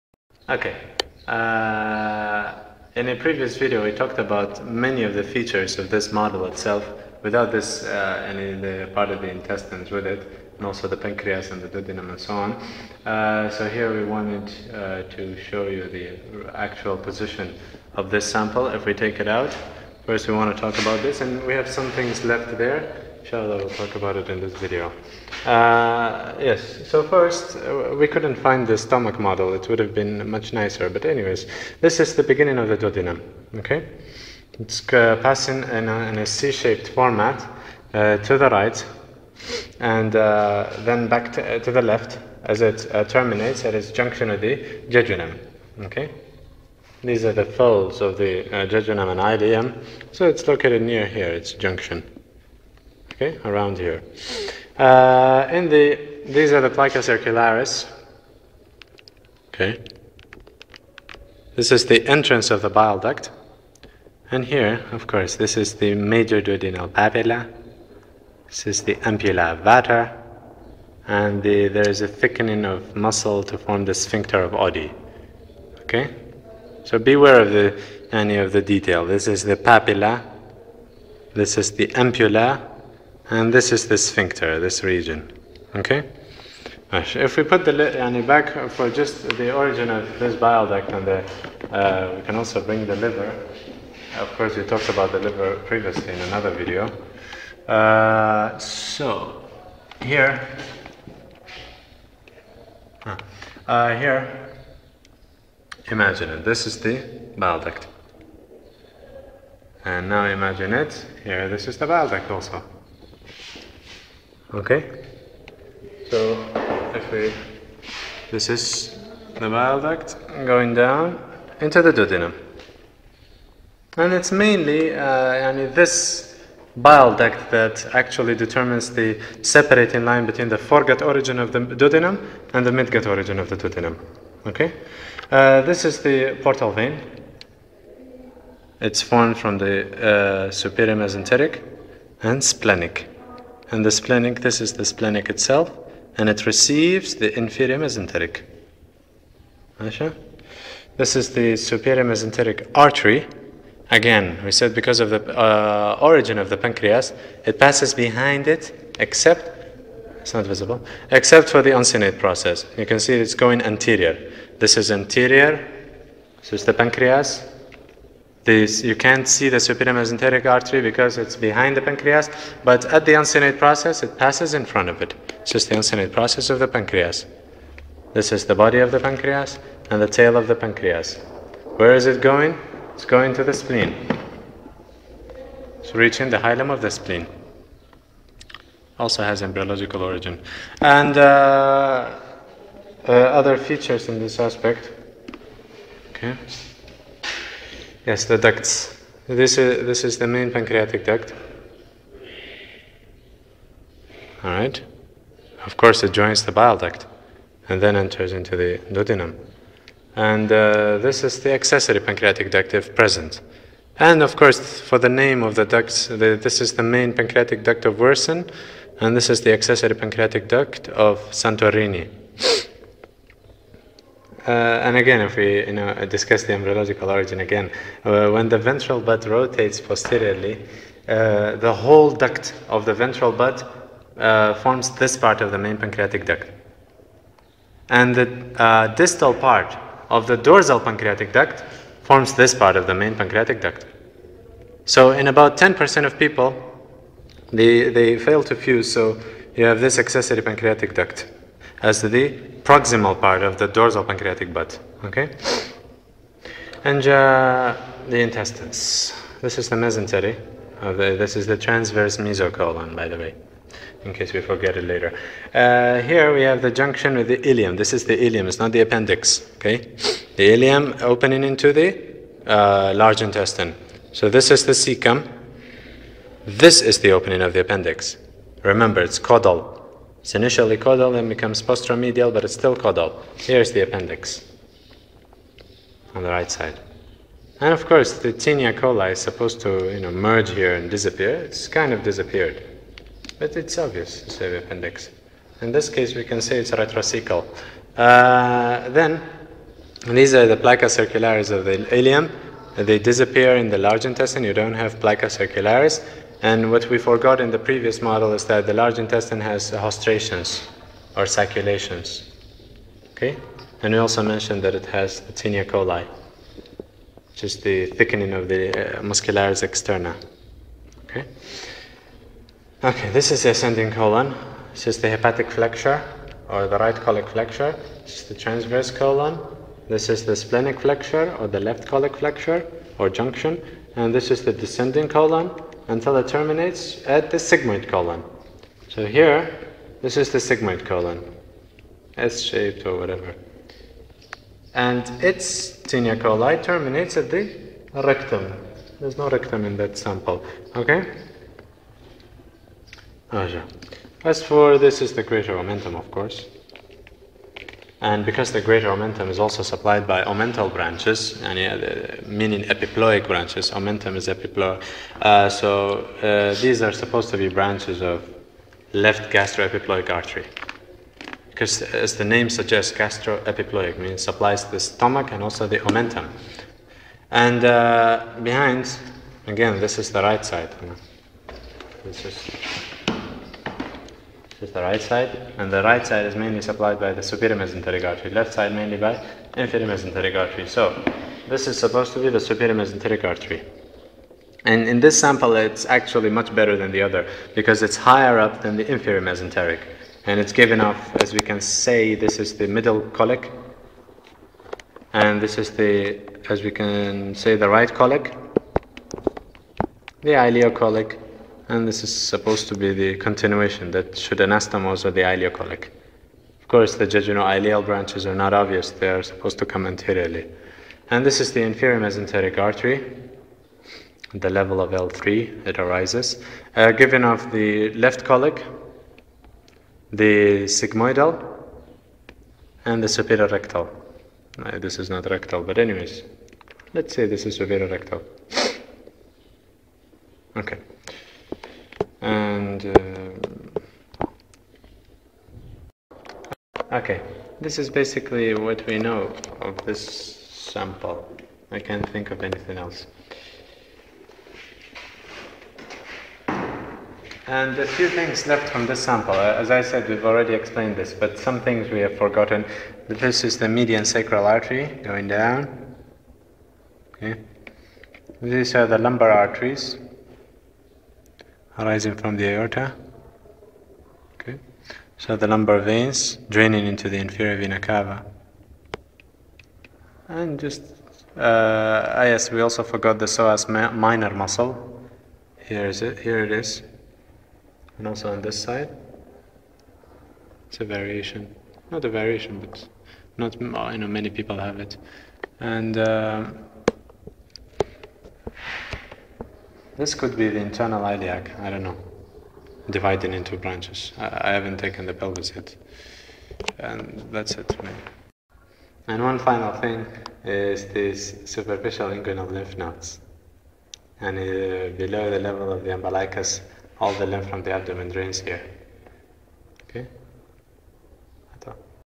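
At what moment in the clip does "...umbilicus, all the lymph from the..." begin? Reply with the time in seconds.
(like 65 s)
515 s.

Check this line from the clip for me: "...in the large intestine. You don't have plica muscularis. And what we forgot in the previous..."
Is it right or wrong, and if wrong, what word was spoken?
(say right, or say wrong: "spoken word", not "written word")
wrong: "circularis", not "muscularis".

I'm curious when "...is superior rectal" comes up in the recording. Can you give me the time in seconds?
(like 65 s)
437 s.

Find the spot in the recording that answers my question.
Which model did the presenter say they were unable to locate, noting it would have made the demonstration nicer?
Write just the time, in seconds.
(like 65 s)
28 s.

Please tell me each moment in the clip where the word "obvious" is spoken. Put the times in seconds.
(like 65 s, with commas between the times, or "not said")
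293 s, 418 s.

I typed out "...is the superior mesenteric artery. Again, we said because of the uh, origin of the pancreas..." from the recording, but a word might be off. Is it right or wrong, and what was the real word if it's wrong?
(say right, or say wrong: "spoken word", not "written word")
right.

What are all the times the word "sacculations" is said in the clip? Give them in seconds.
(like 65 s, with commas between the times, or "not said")
311 s.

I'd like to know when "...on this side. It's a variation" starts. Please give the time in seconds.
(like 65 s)
488 s.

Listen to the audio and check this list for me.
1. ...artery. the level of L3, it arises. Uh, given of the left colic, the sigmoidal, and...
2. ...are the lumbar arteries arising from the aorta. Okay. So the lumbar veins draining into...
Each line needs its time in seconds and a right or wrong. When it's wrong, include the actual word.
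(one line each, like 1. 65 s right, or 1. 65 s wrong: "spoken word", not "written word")
1. 422 s right
2. 468 s right.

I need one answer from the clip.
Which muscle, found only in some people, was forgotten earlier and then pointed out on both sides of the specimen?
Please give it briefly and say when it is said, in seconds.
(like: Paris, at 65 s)
psoas minor, at 483 s.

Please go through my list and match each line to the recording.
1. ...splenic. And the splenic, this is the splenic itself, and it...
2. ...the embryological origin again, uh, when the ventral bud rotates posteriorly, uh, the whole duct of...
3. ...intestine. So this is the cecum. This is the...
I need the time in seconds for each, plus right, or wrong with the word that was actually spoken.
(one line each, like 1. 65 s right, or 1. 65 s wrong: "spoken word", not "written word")
1. 142 s right
2. 226 s right
3. 273 s right.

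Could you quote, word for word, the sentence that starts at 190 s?
And uh, uh, other features in this aspect.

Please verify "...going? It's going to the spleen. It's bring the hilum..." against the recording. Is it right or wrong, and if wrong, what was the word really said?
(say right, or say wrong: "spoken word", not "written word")
wrong: "reaching", not "bring".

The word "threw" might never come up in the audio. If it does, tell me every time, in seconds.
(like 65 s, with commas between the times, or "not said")
not said.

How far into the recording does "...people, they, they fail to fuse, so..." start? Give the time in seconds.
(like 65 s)
246 s.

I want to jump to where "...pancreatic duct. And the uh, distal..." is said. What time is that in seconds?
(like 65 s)
235 s.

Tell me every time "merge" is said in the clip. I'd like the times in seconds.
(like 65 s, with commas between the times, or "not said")
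290 s.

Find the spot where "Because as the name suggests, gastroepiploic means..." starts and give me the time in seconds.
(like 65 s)
371 s.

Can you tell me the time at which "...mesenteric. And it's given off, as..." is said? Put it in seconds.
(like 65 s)
399 s.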